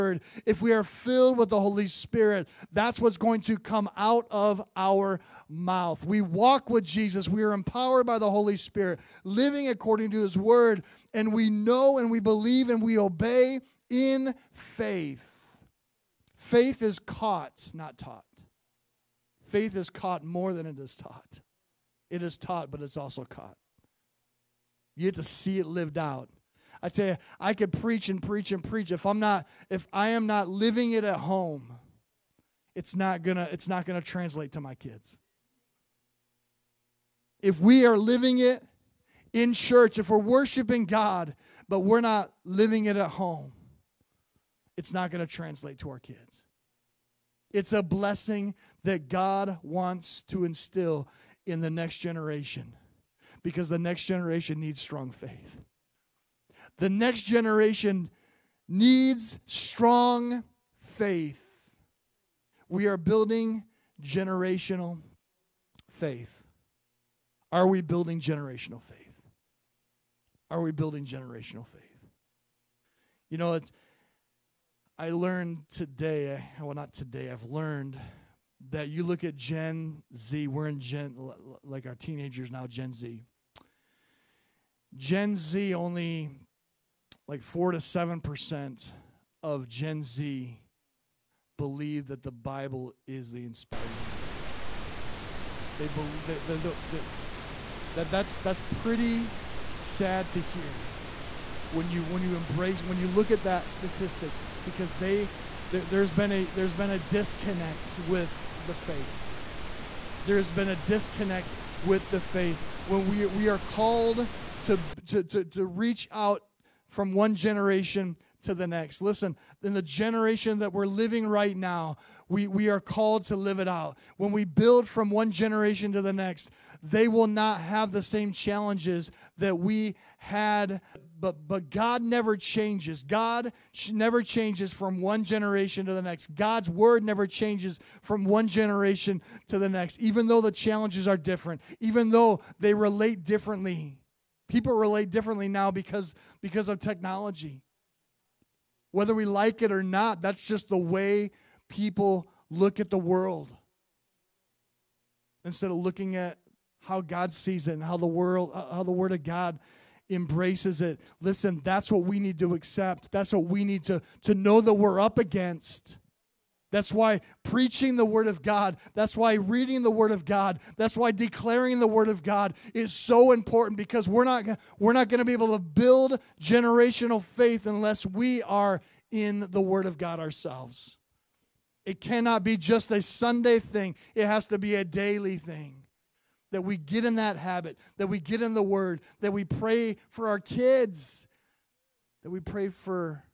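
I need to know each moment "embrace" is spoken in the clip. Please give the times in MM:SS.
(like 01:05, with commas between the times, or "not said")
01:42, 02:40.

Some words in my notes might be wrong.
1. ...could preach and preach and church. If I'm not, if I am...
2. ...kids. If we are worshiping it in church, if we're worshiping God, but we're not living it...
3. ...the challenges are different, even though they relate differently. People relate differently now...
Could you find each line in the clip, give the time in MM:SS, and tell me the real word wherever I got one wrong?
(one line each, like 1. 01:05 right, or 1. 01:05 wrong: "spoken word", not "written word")
1. 00:27 wrong: "preach", not "church"
2. 00:34 wrong: "living", not "worshiping"
3. 02:20 right.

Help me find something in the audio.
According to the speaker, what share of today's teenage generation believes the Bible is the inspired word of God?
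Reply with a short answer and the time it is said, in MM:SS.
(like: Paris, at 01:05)
4 to 7%, at 01:27.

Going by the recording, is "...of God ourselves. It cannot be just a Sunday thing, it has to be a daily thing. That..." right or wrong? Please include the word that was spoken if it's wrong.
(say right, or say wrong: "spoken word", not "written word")
right.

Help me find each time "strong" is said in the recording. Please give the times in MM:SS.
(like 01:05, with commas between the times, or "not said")
00:54, 00:59.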